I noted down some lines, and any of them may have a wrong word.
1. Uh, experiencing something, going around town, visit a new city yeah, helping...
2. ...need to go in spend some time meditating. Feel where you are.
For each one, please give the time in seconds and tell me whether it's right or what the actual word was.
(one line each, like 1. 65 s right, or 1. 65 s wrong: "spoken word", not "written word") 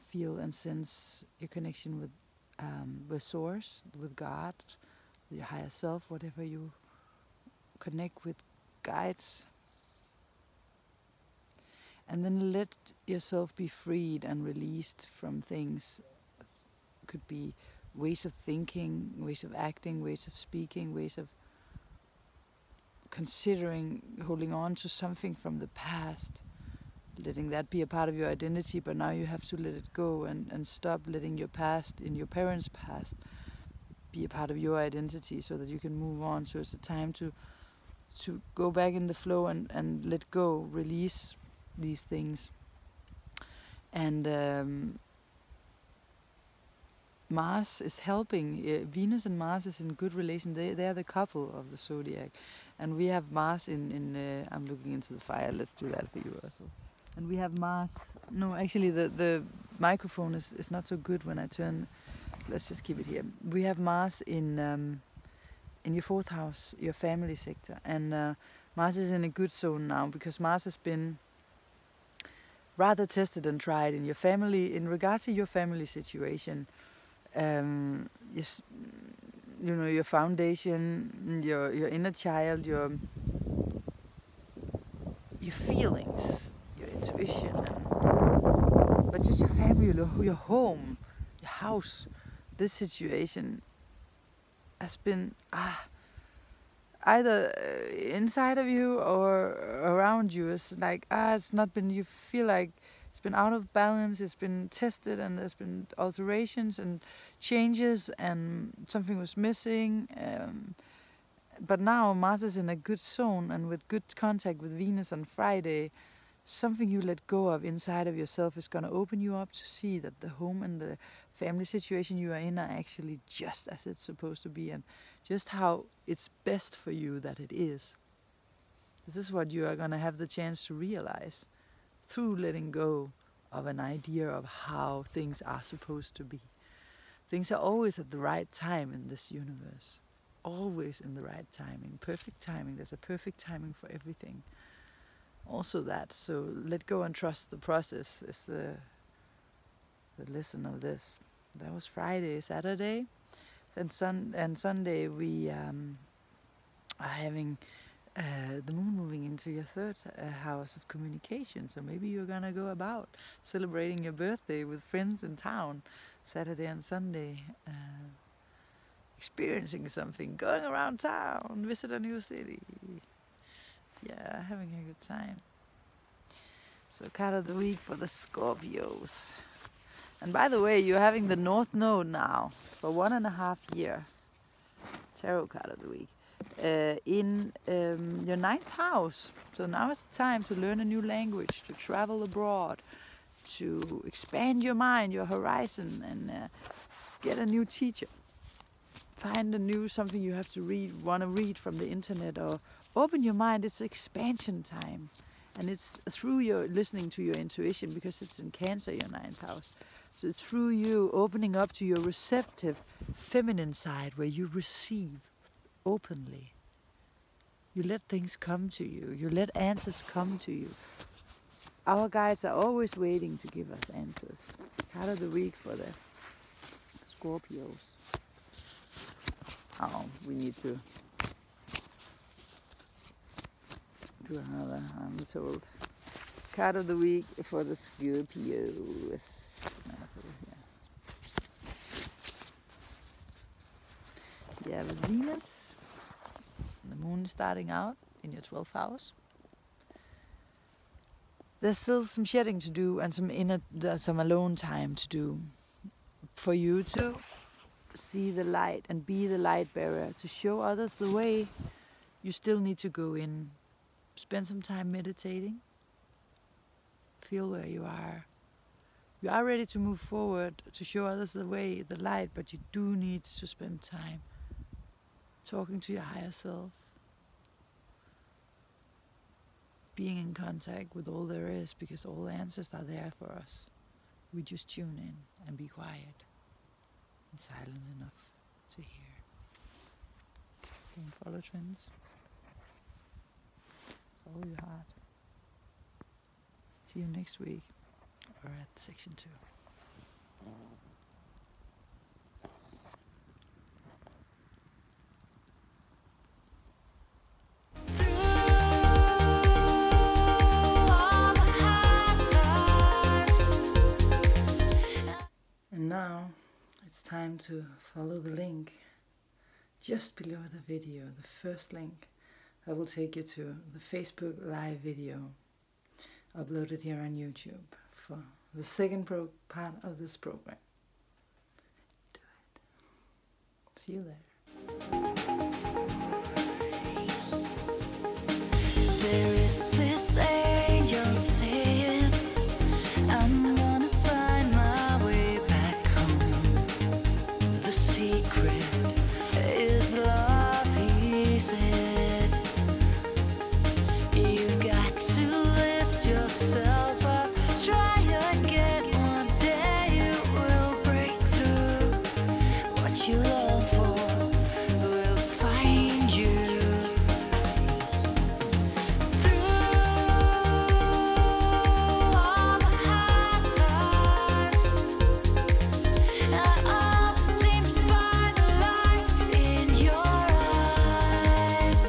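1. 167 s wrong: "having", not "helping"
2. 262 s right.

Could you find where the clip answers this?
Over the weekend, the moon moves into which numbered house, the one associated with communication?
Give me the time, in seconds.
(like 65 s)
159 s.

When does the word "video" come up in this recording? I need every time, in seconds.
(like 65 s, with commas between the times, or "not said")
320 s, 324 s.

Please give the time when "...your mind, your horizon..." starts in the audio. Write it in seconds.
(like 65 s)
194 s.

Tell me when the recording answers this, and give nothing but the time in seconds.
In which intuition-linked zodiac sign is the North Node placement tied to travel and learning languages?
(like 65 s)
208 s.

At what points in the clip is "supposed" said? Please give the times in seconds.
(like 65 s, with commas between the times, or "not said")
124 s, 135 s.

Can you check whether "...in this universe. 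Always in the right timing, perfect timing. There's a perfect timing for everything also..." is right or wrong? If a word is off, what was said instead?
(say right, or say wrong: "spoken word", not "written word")
right.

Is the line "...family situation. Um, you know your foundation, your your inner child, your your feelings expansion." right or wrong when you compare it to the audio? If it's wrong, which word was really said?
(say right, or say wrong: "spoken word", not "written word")
wrong: "intuition", not "expansion".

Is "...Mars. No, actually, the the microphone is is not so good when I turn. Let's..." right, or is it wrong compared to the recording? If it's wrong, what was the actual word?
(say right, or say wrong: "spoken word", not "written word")
right.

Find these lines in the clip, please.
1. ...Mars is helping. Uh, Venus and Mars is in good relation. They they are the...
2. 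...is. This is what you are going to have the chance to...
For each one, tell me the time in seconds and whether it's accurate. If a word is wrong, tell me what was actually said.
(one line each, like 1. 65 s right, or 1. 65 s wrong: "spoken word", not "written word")
1. 47 s right
2. 127 s right.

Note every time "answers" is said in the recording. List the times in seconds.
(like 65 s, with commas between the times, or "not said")
219 s, 223 s, 282 s.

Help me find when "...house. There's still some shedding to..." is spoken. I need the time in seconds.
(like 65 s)
248 s.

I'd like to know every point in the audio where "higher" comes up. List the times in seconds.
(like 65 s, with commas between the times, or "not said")
5 s, 276 s.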